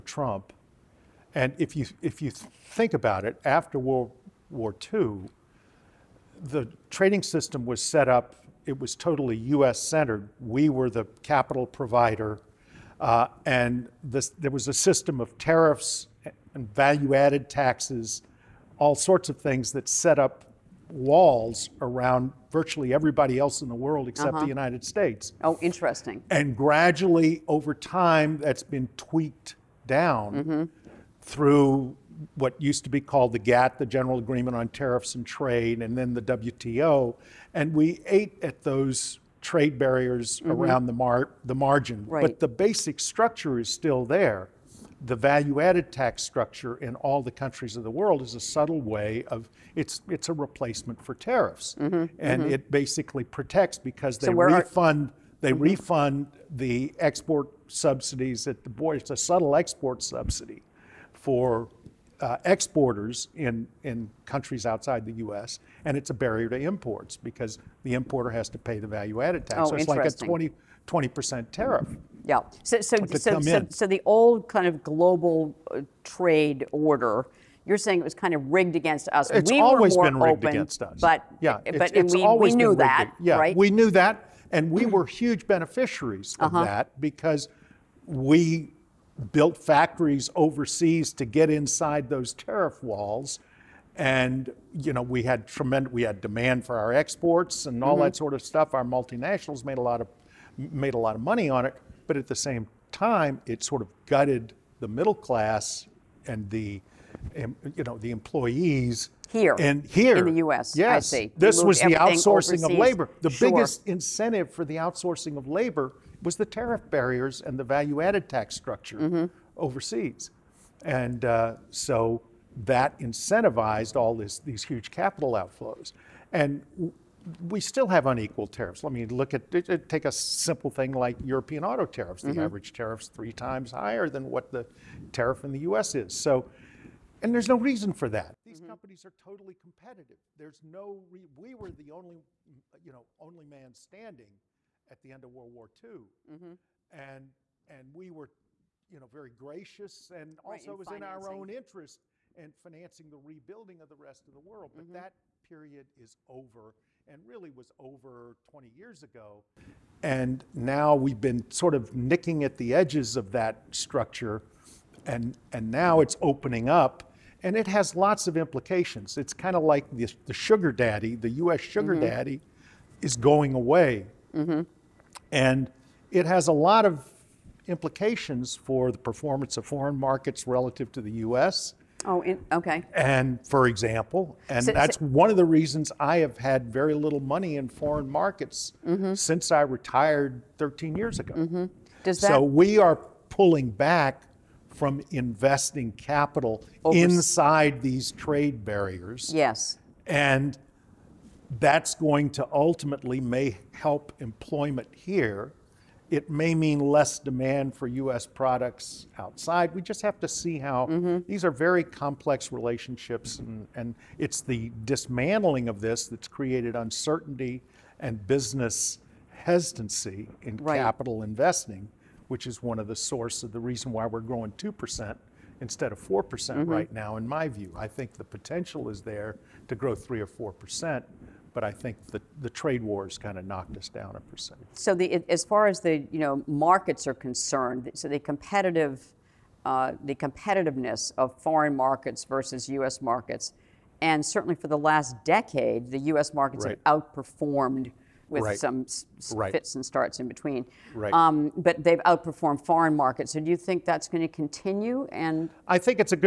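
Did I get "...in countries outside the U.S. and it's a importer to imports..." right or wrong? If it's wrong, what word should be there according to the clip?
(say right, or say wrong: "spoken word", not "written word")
wrong: "barrier", not "importer".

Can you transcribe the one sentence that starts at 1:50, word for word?
Yes, this was the outsourcing overseas.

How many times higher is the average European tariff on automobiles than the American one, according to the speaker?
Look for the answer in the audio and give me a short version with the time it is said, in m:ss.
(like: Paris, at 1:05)
3, at 2:13.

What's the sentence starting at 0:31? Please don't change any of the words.
through what used to be called the GATT, the General Agreement on Tariffs and Trade, and then the WTO.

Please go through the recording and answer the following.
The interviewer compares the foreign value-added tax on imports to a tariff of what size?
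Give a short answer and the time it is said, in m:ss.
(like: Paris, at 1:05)
20 percent, at 1:10.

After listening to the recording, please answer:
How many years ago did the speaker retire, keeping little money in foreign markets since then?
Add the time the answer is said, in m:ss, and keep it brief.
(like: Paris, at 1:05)
13, at 3:10.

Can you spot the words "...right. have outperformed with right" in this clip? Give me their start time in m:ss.
4:06.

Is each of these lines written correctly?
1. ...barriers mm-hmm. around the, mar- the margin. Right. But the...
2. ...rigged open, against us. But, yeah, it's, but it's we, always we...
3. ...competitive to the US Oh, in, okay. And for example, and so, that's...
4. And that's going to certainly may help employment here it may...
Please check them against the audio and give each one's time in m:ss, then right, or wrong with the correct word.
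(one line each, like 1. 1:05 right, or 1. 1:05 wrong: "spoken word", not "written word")
1. 0:39 right
2. 1:20 right
3. 3:00 wrong: "relative", not "competitive"
4. 3:20 wrong: "ultimately", not "certainly".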